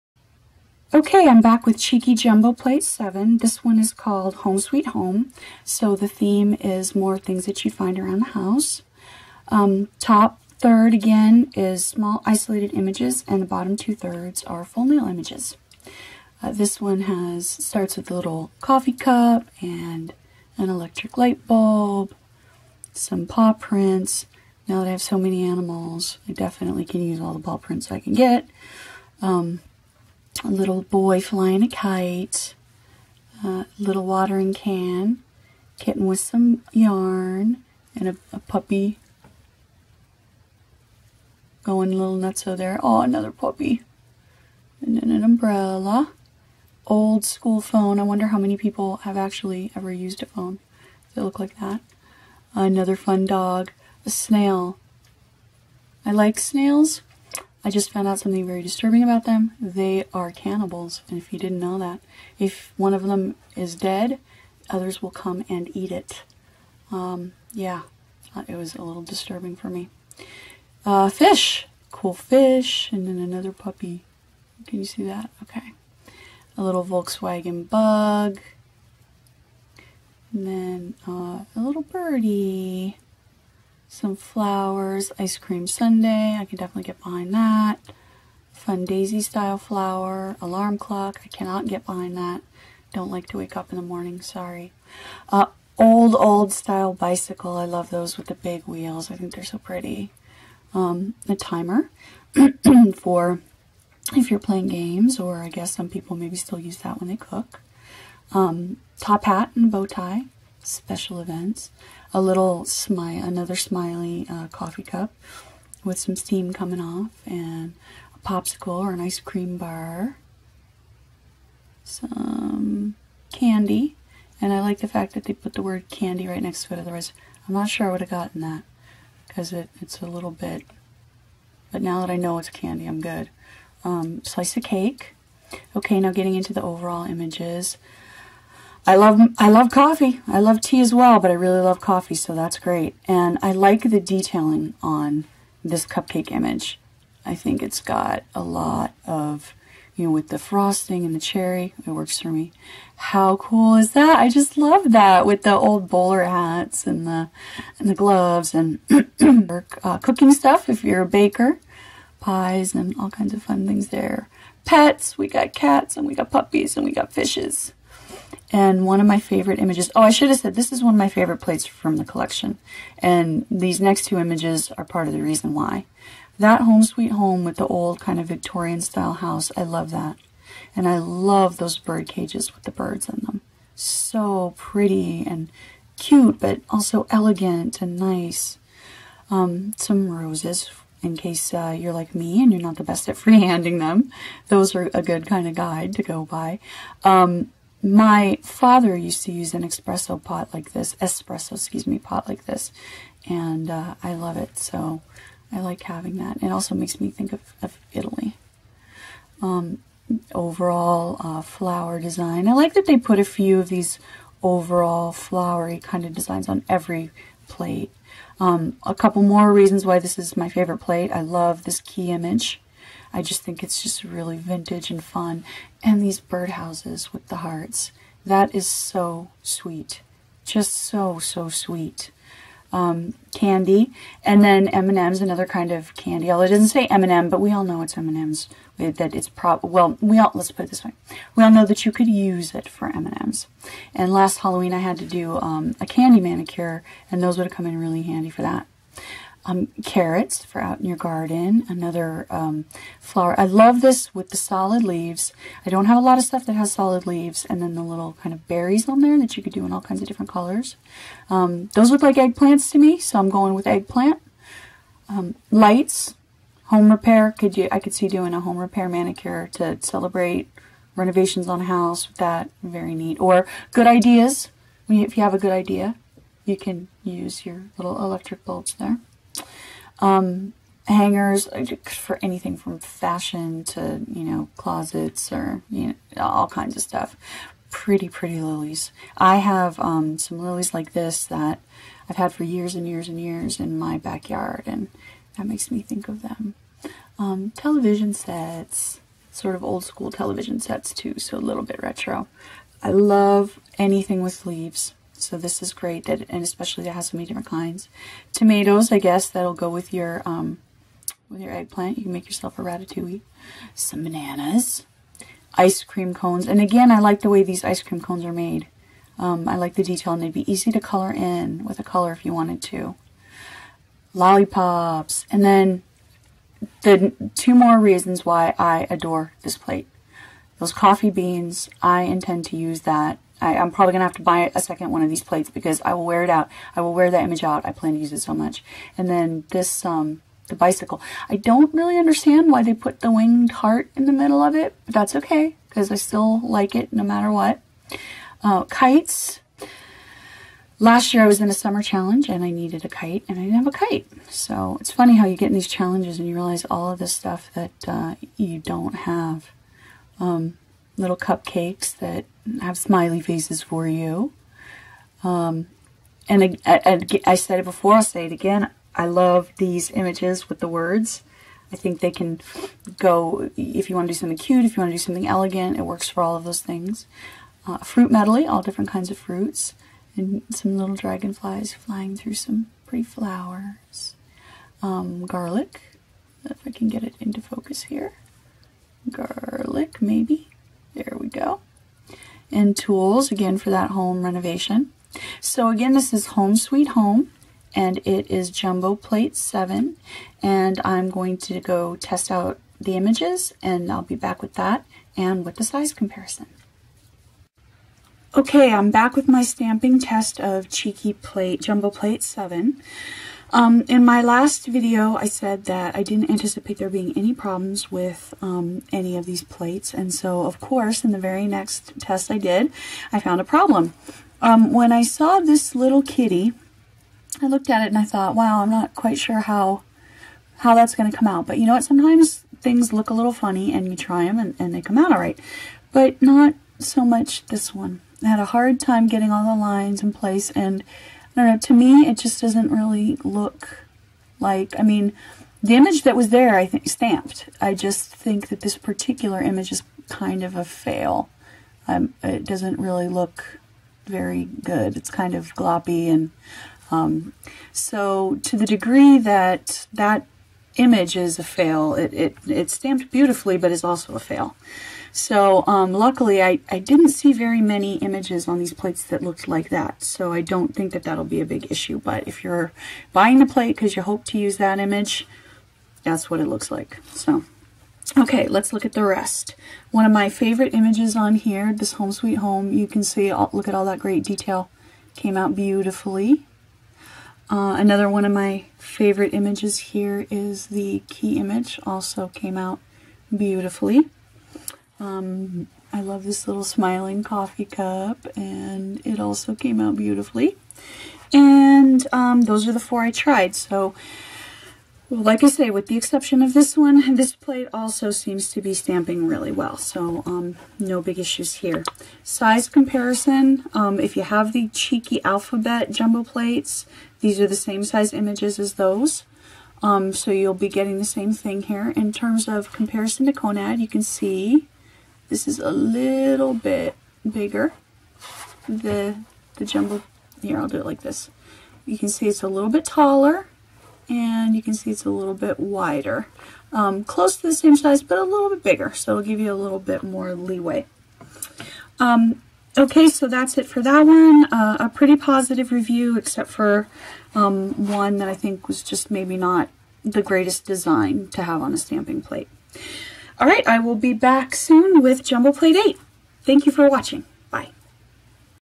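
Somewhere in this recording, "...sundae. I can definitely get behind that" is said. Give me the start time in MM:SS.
01:25.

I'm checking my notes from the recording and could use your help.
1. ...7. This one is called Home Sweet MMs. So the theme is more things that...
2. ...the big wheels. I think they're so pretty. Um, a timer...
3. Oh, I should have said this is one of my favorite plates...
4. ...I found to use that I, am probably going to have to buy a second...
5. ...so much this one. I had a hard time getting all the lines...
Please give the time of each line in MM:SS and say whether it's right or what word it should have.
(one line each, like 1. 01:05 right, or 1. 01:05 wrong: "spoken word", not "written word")
1. 00:02 wrong: "Home", not "MMs"
2. 01:38 right
3. 02:49 right
4. 05:31 wrong: "intend", not "found"
5. 07:16 right.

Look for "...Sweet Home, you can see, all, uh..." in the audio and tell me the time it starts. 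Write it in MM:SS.
08:02.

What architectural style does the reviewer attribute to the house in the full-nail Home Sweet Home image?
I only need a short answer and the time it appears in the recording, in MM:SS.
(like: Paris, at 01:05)
Victorian, at 02:58.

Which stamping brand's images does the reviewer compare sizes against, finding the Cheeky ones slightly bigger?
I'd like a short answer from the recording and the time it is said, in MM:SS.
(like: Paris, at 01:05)
Konad, at 08:43.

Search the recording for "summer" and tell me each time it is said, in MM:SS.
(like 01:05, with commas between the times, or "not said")
05:51.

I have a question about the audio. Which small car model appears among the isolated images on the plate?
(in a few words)
Volkswagen bug.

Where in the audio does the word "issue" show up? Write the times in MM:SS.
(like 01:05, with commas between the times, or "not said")
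07:51, 08:31.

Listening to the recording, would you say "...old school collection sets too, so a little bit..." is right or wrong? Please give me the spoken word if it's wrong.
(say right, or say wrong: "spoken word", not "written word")
wrong: "television", not "collection".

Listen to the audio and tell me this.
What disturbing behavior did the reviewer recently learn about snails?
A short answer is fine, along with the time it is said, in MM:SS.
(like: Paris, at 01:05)
They are cannibals, at 00:59.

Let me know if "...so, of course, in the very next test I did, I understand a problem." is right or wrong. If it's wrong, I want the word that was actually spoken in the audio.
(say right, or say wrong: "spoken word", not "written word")
wrong: "found", not "understand".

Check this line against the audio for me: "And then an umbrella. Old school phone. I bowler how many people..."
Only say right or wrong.
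wrong.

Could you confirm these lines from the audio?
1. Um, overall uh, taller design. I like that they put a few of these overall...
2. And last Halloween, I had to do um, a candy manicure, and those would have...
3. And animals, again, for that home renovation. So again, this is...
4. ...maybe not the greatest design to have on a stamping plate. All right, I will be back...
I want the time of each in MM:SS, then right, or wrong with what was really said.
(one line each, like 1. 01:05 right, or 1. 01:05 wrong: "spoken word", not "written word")
1. 03:29 wrong: "flower", not "taller"
2. 04:03 right
3. 06:32 wrong: "tools", not "animals"
4. 09:09 right.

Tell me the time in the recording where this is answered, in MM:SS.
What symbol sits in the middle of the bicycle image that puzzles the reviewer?
05:43.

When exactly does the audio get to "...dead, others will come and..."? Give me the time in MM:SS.
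01:03.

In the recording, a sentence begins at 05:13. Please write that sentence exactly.
Some bananas, ice cream cones, and again, I like the way these ice cream cones are made.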